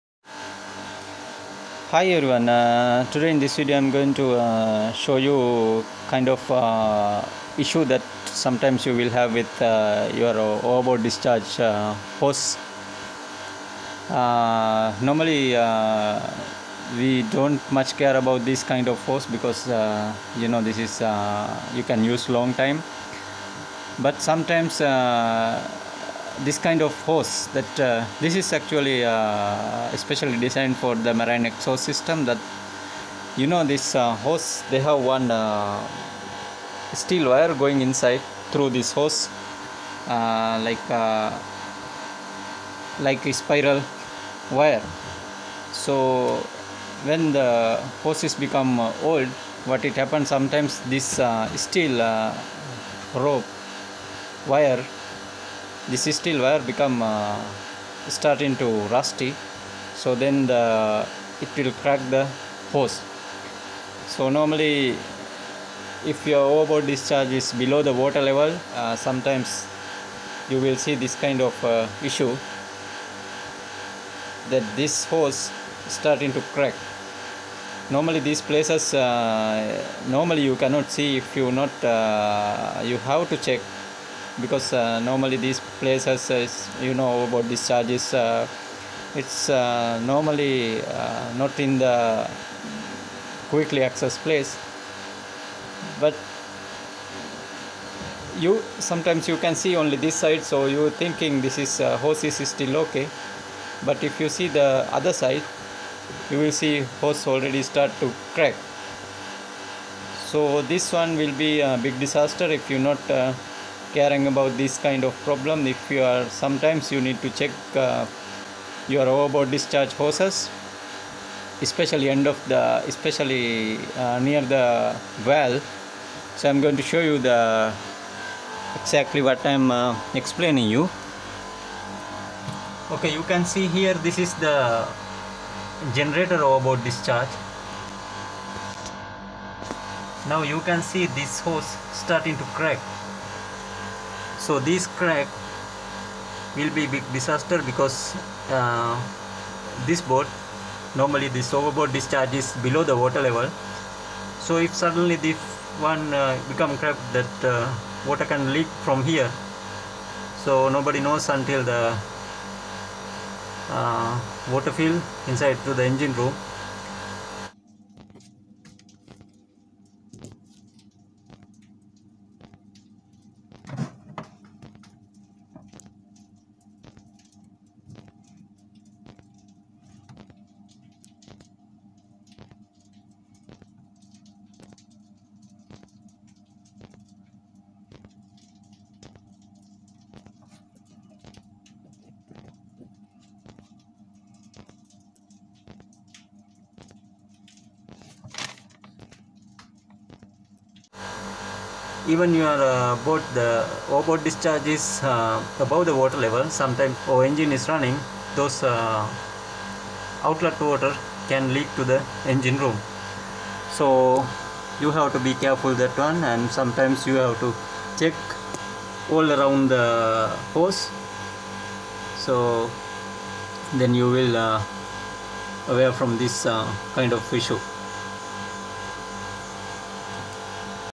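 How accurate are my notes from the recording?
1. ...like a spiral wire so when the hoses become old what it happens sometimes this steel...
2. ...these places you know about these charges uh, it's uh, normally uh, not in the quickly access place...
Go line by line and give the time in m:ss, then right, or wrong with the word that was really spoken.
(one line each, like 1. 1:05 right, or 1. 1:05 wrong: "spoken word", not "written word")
1. 0:42 right
2. 1:25 right.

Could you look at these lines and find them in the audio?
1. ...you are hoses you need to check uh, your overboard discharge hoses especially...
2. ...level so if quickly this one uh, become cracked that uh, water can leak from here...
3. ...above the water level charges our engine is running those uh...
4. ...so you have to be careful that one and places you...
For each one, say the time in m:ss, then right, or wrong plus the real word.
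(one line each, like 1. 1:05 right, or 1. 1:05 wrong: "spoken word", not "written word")
1. 1:55 wrong: "sometimes", not "hoses"
2. 2:33 wrong: "suddenly", not "quickly"
3. 3:25 wrong: "sometimes", not "charges"
4. 3:33 wrong: "sometimes", not "places".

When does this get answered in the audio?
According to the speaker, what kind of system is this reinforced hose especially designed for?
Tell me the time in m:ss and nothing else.
0:31.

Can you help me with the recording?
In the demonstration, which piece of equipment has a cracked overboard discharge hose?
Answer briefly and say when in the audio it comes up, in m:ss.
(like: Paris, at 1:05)
generator, at 2:15.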